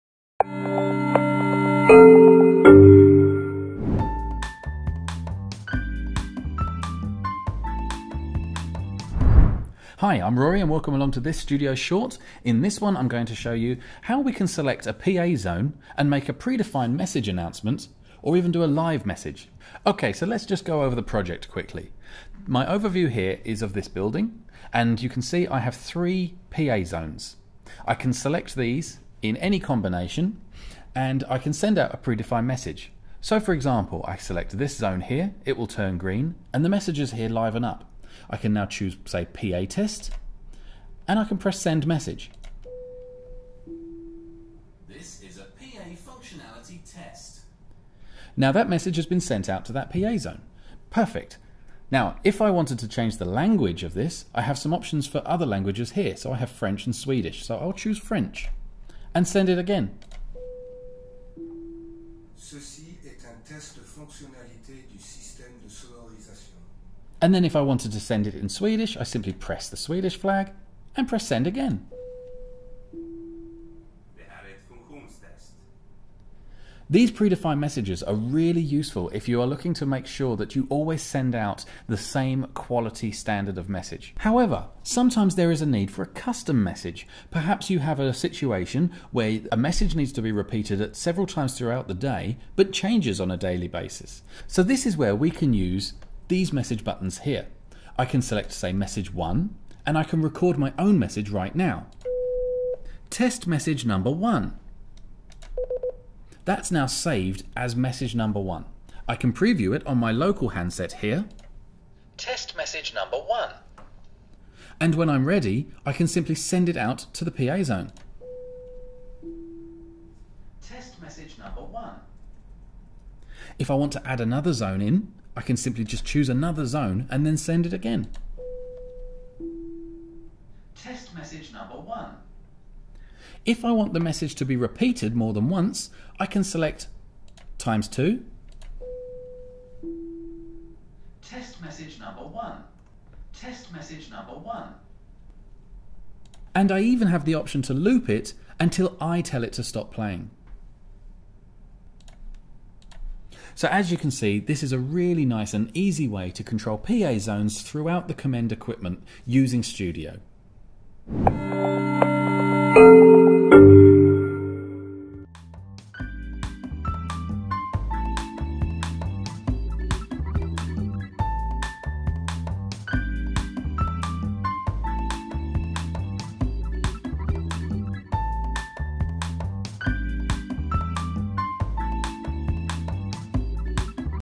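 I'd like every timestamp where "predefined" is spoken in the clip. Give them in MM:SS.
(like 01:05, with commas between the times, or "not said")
00:16, 00:31, 01:17.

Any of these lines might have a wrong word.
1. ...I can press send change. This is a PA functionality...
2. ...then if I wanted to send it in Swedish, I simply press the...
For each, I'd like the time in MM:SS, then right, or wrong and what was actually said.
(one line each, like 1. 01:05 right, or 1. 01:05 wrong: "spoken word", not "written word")
1. 00:41 wrong: "message", not "change"
2. 01:07 right.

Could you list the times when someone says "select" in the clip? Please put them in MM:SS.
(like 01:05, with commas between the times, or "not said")
00:14, 00:28, 00:34, 01:38, 02:16.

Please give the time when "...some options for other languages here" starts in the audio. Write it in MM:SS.
00:54.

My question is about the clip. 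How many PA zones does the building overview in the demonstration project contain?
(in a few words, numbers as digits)
3.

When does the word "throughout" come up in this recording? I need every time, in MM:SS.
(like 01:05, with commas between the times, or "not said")
01:31, 02:37.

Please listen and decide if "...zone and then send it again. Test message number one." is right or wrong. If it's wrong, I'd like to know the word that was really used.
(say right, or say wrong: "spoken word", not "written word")
right.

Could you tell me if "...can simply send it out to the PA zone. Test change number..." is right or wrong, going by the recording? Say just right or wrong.
wrong.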